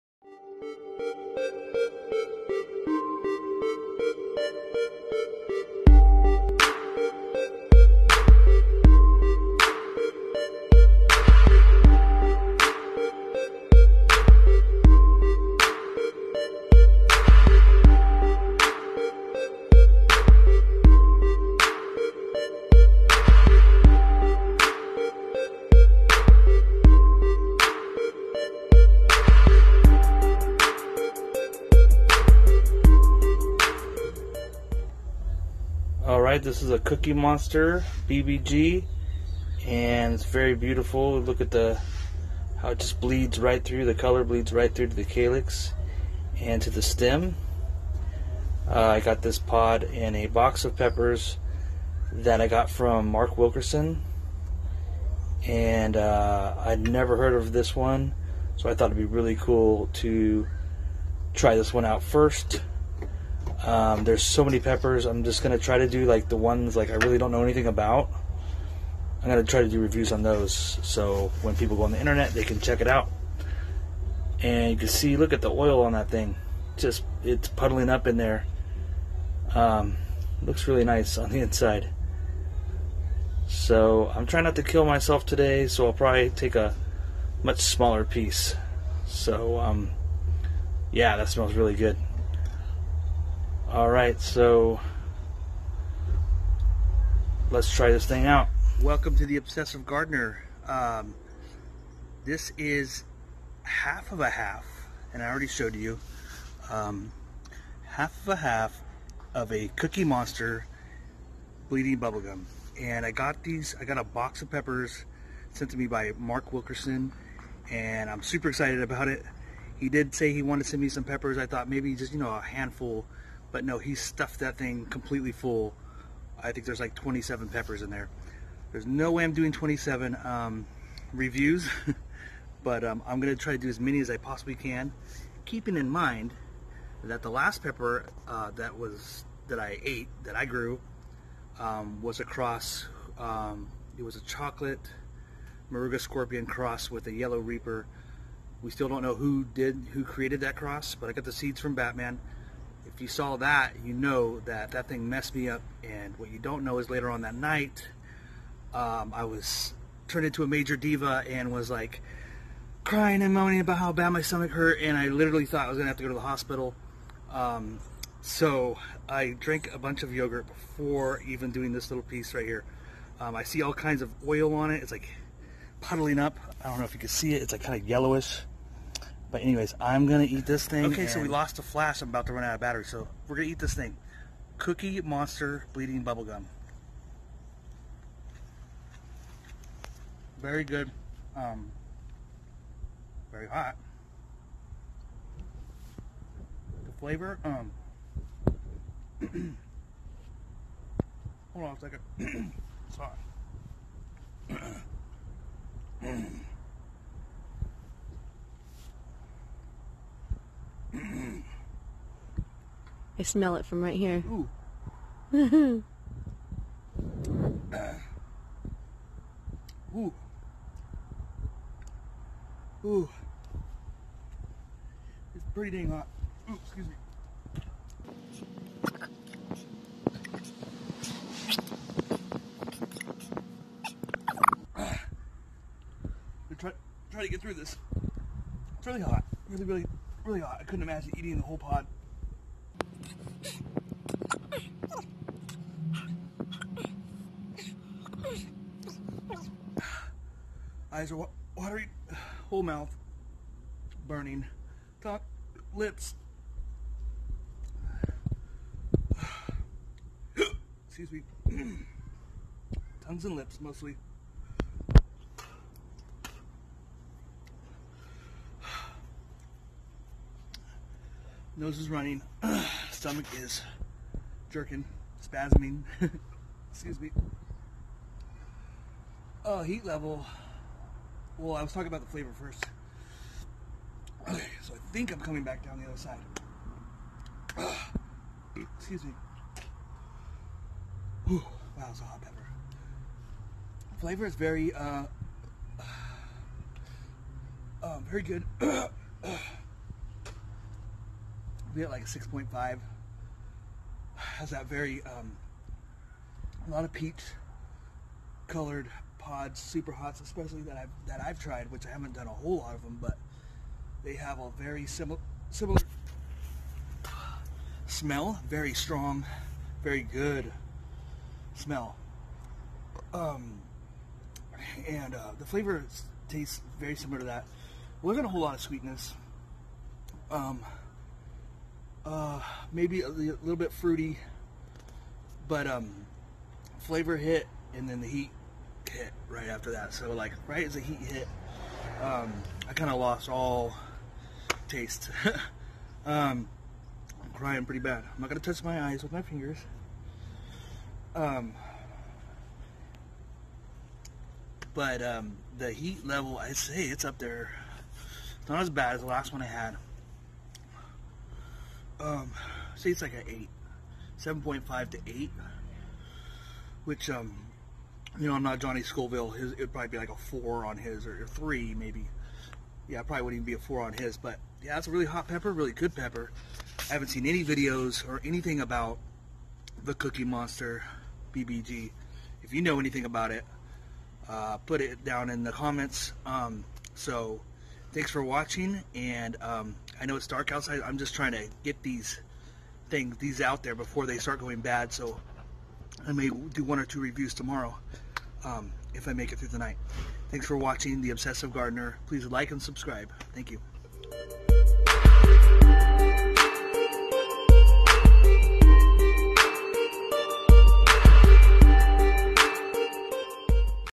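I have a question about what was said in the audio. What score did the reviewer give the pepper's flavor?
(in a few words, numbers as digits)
6.5.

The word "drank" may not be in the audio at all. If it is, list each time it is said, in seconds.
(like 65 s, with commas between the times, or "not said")
169 s.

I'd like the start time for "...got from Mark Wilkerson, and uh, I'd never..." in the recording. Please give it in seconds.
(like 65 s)
52 s.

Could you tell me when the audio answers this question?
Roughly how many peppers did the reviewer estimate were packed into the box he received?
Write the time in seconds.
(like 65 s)
126 s.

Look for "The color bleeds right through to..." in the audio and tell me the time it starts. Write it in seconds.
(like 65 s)
43 s.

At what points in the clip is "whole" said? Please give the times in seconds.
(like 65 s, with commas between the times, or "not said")
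241 s, 252 s, 312 s, 328 s.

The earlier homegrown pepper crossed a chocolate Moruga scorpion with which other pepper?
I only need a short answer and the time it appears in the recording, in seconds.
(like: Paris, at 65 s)
yellow reaper, at 147 s.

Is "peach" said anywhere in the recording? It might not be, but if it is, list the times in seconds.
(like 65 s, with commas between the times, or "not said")
306 s.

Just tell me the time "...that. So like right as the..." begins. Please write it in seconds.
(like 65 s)
339 s.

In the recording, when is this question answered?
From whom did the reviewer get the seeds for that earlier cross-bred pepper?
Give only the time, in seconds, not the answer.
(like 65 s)
151 s.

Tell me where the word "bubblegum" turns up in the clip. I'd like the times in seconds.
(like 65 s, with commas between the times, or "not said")
111 s, 186 s.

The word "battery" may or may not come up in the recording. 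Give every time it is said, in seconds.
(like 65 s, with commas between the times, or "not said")
182 s.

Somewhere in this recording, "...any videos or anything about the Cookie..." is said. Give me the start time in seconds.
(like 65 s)
377 s.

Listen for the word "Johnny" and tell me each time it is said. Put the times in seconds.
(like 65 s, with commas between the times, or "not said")
368 s.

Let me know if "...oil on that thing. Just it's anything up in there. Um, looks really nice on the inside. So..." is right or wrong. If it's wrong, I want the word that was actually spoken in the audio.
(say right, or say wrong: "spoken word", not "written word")
wrong: "puddling", not "anything".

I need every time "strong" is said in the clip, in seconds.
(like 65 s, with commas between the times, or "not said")
318 s.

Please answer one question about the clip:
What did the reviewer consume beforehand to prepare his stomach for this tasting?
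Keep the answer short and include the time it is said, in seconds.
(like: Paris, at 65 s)
yogurt, at 170 s.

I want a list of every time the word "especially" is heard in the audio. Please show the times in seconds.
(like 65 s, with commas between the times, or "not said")
310 s.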